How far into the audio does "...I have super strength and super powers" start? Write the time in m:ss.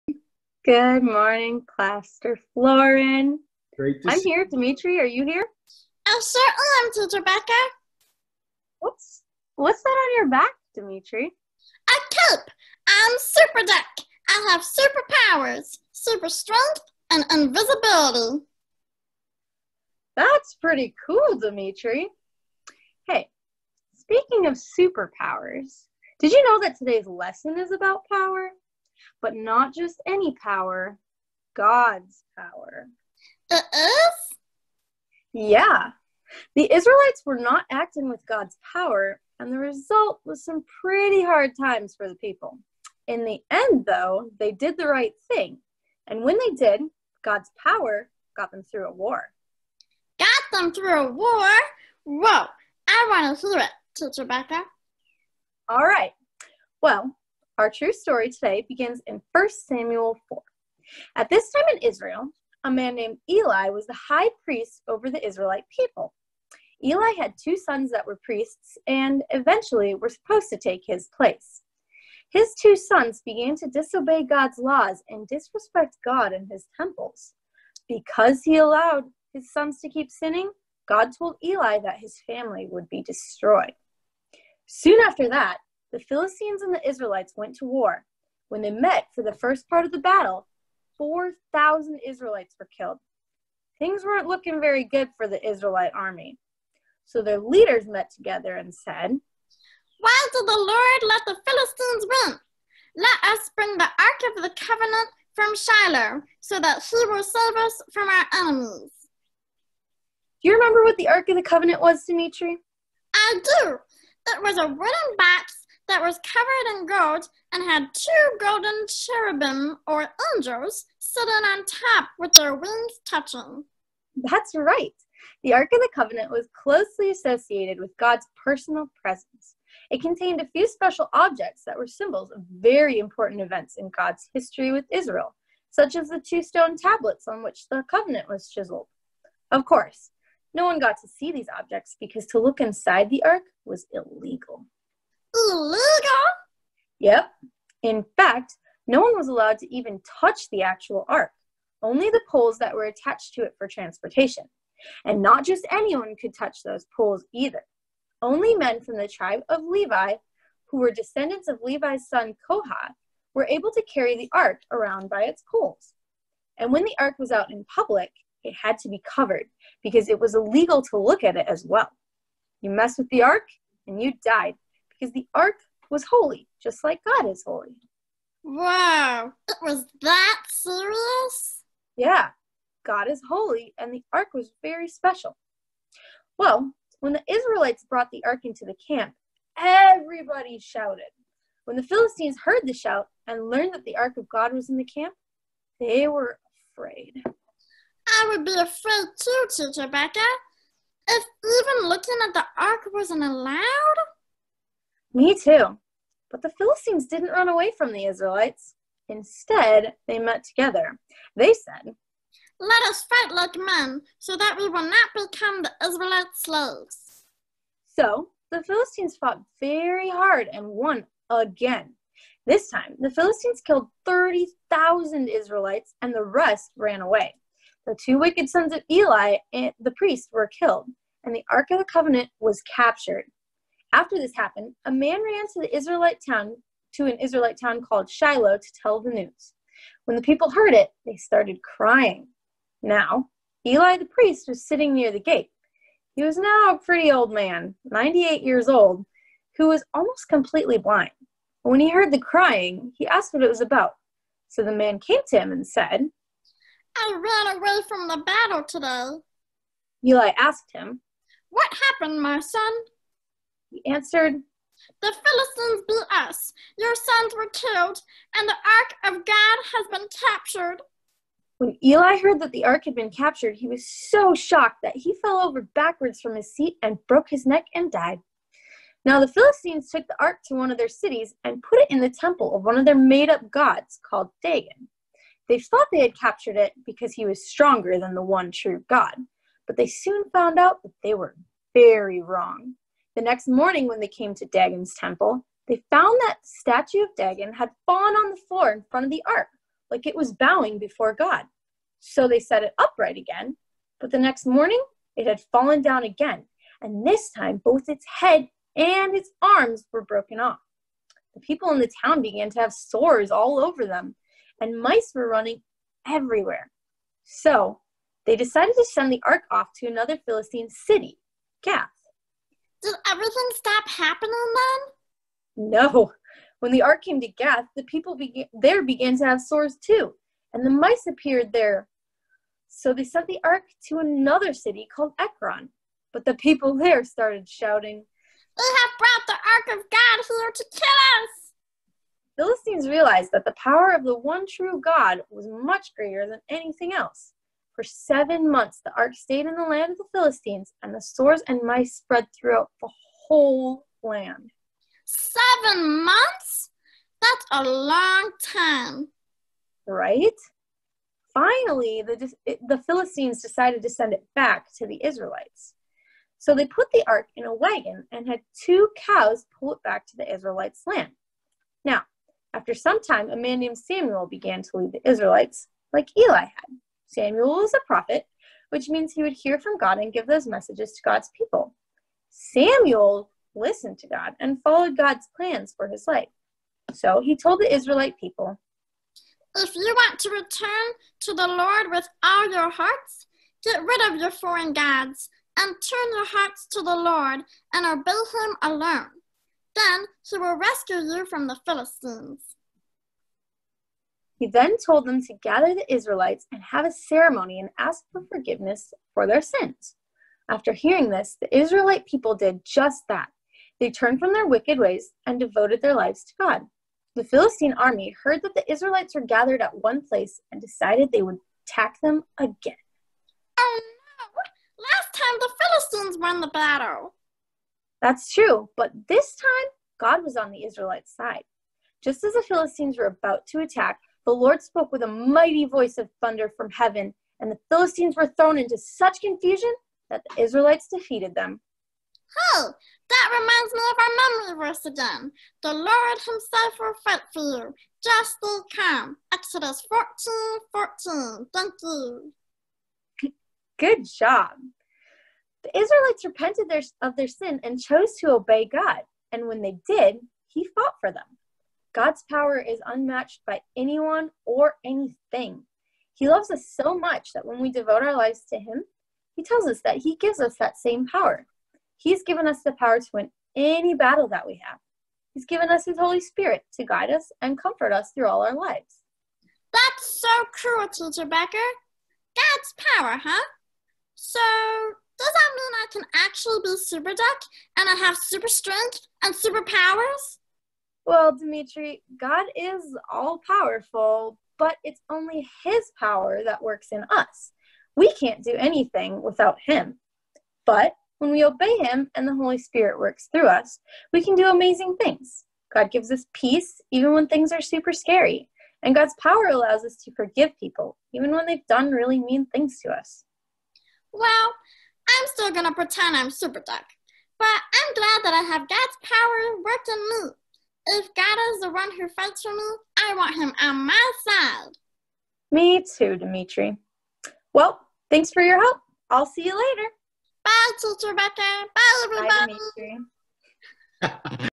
8:07.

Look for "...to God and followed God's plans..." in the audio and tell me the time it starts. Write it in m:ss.
6:23.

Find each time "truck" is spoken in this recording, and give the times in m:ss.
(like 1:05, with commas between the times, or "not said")
not said.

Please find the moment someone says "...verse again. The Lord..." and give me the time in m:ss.
7:24.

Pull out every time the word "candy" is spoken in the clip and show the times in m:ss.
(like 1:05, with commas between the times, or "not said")
not said.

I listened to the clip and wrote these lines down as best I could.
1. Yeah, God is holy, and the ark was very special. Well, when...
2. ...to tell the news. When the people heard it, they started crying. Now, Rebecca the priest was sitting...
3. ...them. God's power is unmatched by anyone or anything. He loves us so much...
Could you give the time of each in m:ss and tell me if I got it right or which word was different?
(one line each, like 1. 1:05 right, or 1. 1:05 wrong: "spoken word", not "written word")
1. 3:01 right
2. 3:58 wrong: "Eli", not "Rebecca"
3. 7:41 right.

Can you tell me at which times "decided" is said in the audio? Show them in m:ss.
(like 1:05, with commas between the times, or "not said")
5:18, 6:03, 7:00.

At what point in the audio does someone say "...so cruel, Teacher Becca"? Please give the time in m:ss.
8:00.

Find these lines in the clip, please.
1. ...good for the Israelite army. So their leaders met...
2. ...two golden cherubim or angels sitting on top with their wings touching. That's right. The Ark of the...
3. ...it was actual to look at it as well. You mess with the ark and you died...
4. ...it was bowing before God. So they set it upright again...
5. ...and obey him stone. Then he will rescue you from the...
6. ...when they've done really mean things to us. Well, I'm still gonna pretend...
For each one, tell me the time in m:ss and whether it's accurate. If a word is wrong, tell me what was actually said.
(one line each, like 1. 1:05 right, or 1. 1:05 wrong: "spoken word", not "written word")
1. 1:34 right
2. 1:57 right
3. 2:50 wrong: "illegal", not "actual"
4. 5:00 right
5. 6:37 wrong: "alone", not "stone"
6. 8:31 right.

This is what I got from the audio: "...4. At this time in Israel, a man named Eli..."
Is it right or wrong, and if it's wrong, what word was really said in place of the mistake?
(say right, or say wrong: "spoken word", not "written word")
right.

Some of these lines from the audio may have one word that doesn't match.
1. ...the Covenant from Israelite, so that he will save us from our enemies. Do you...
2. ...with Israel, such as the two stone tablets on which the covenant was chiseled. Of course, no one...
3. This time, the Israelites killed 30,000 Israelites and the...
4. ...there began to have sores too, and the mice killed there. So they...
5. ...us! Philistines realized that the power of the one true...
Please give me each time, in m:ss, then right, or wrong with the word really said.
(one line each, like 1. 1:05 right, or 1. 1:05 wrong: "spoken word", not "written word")
1. 1:44 wrong: "Shiloh", not "Israelite"
2. 2:14 right
3. 3:42 wrong: "Philistines", not "Israelites"
4. 5:28 wrong: "appeared", not "killed"
5. 5:41 right.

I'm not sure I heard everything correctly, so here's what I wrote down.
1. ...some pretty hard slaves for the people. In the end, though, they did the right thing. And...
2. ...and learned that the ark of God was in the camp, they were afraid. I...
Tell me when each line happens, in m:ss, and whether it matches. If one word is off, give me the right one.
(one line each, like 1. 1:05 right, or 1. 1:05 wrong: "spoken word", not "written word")
1. 0:40 wrong: "times", not "slaves"
2. 3:13 right.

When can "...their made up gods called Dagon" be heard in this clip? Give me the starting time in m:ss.
4:42.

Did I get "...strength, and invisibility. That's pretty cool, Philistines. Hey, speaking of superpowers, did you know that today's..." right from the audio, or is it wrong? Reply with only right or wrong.
wrong.